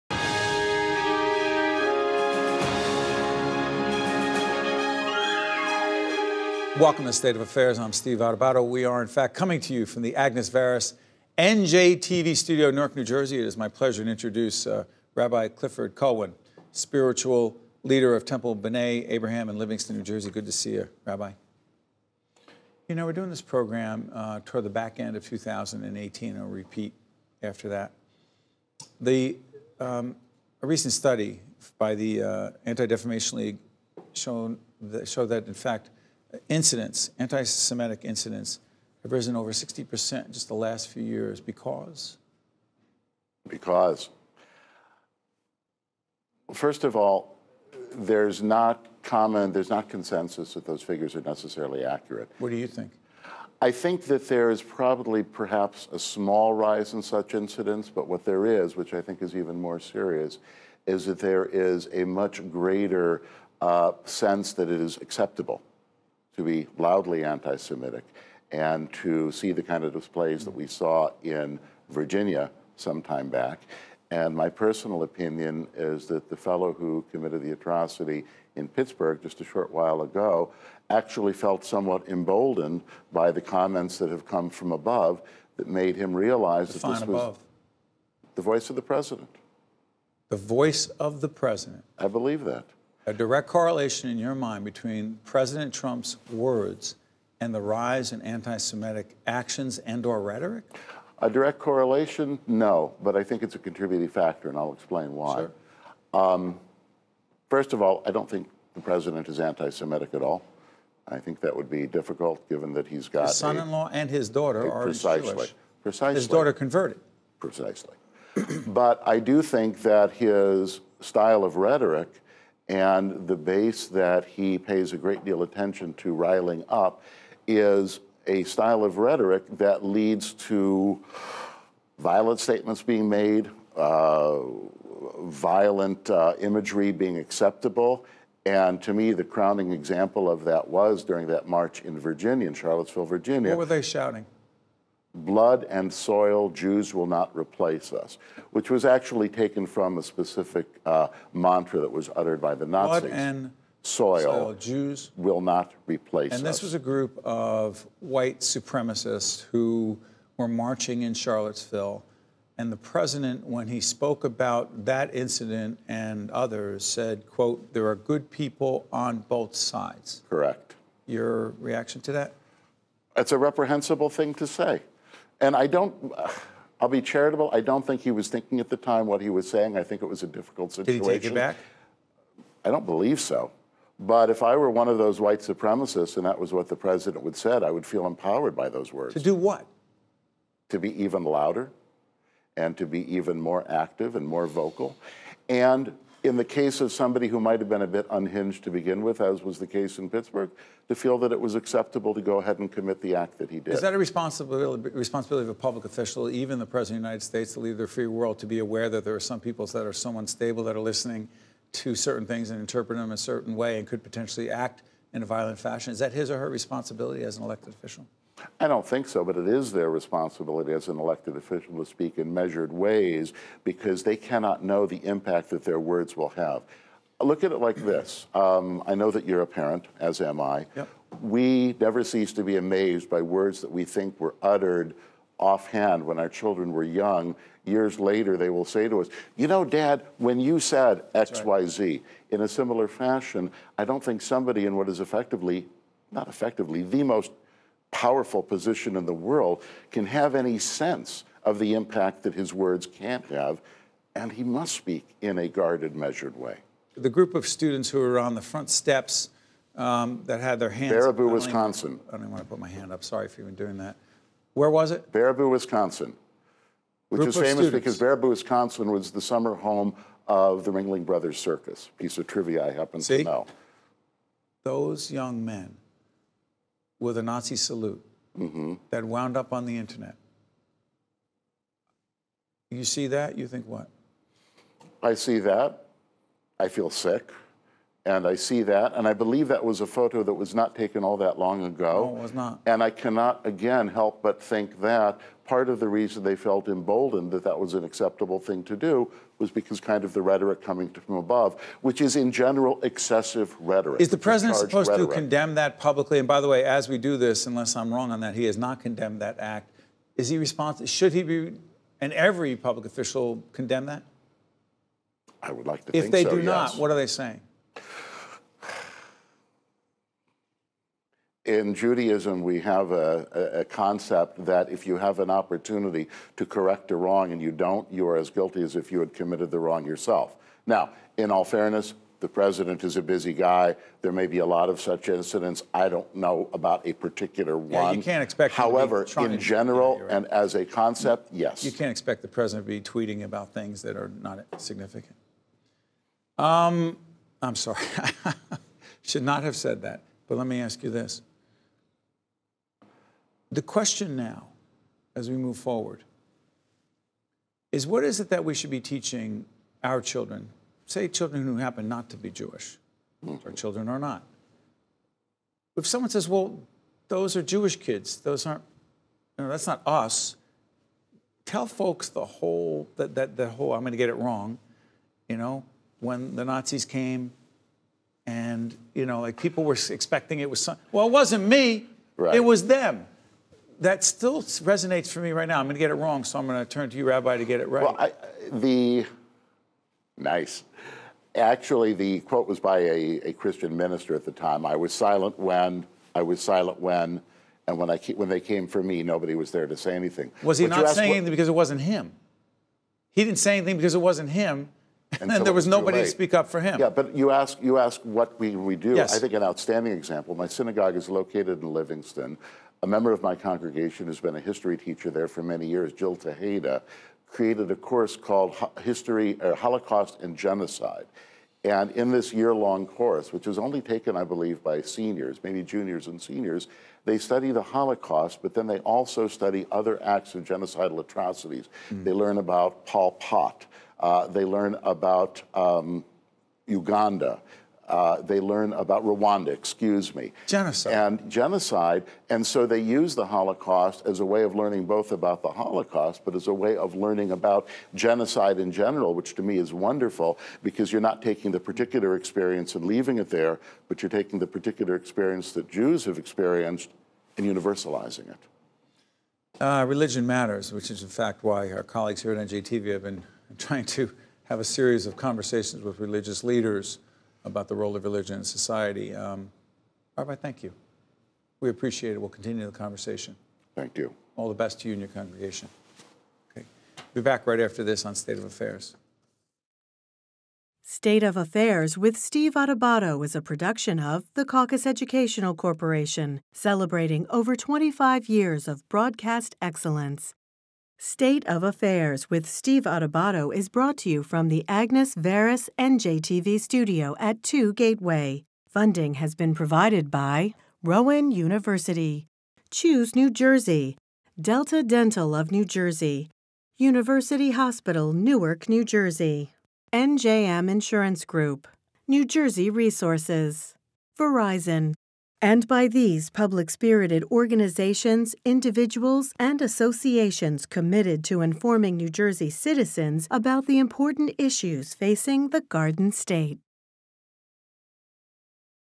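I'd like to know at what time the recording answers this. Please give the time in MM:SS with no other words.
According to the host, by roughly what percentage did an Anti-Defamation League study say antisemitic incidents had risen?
00:39.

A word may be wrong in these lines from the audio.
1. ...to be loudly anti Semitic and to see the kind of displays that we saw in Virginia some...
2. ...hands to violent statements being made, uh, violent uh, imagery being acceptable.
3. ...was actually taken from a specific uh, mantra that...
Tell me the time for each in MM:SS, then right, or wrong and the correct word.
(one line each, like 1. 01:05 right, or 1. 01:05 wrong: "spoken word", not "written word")
1. 01:06 right
2. 02:09 wrong: "leads", not "hands"
3. 02:28 right.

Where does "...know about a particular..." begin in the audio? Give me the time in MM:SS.
05:36.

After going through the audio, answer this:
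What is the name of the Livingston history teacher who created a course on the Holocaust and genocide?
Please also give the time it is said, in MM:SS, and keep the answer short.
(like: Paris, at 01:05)
Jill Tejeda, at 06:55.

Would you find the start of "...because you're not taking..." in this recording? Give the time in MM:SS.
07:30.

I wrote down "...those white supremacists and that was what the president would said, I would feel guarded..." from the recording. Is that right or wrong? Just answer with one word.
wrong.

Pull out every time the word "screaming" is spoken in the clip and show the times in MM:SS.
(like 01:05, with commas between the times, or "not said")
not said.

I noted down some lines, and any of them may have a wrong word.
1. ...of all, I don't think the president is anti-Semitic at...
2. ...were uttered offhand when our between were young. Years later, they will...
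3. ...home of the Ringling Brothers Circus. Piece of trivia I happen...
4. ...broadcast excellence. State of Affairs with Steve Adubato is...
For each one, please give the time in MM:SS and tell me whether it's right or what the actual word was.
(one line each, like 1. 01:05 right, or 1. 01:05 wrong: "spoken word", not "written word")
1. 01:47 right
2. 03:54 wrong: "children", not "between"
3. 04:29 right
4. 08:08 right.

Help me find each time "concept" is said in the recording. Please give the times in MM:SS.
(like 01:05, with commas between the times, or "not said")
05:23, 05:40.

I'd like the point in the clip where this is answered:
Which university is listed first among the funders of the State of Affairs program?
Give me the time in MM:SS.
08:20.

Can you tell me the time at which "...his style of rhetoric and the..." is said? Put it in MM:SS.
02:00.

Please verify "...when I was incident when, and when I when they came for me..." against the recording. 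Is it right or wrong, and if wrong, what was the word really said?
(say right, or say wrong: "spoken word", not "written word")
wrong: "silent", not "incident".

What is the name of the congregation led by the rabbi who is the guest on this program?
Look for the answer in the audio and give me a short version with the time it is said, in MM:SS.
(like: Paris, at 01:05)
Temple B'nai Abraham, at 00:18.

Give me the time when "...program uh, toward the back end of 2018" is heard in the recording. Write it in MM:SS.
00:23.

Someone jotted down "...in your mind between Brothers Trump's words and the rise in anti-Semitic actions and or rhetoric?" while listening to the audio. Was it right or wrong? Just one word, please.
wrong.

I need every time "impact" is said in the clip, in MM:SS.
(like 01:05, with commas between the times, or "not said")
03:45, 04:11.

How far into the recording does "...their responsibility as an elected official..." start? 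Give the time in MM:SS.
03:39.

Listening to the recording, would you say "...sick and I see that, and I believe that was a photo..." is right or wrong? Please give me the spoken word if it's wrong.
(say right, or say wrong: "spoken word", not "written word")
right.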